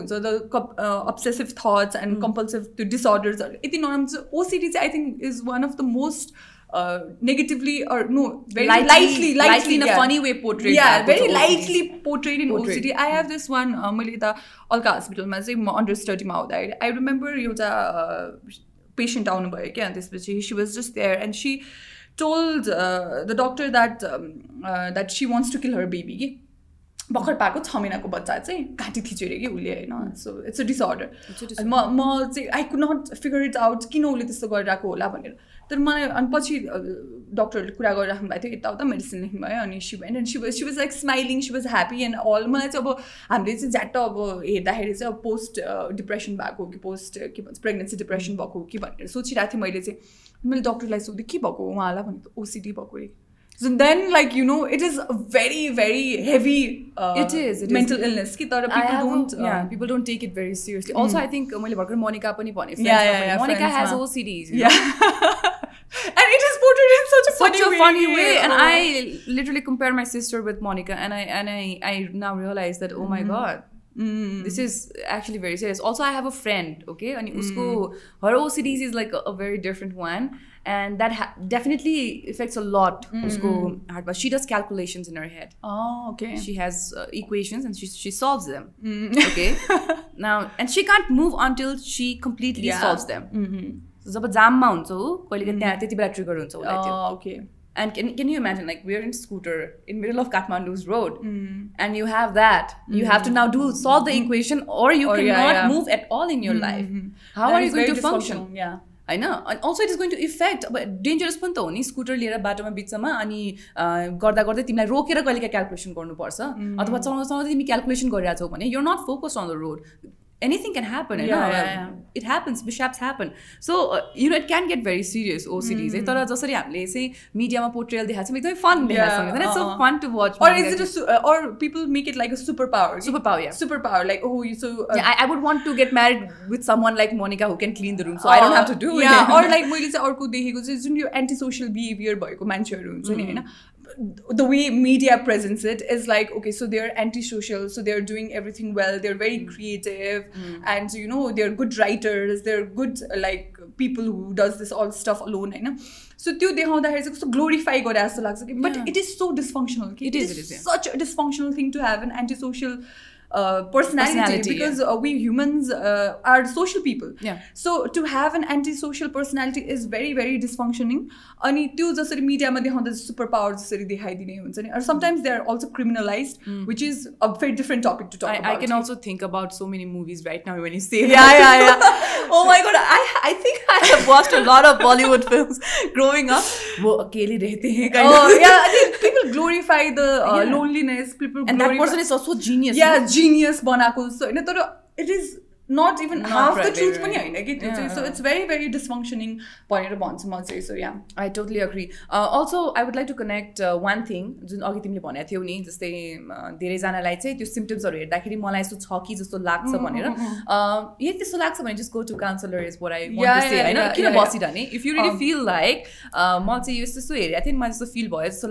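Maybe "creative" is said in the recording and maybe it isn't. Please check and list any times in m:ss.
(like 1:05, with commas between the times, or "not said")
2:29.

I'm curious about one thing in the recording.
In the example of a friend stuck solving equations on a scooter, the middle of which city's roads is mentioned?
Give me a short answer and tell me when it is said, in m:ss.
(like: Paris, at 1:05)
Kathmandu, at 1:40.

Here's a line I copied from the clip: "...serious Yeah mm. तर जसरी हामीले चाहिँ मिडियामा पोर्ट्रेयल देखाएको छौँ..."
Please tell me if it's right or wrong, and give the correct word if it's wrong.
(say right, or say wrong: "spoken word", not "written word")
wrong: "OCDs", not "Yeah".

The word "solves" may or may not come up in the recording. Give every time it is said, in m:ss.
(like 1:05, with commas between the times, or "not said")
1:28, 1:32, 1:43.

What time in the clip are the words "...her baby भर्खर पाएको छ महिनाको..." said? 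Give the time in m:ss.
0:25.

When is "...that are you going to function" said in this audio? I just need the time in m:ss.
1:47.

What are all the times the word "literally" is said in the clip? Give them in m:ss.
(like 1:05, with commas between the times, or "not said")
1:09.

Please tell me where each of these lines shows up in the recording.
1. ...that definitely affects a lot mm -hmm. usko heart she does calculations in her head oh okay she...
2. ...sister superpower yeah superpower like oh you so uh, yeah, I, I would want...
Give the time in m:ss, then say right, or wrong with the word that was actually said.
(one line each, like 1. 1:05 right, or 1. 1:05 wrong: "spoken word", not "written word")
1. 1:20 right
2. 2:12 wrong: "superpower", not "sister".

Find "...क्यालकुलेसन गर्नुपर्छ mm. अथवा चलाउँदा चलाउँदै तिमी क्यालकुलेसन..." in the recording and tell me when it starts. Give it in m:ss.
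1:55.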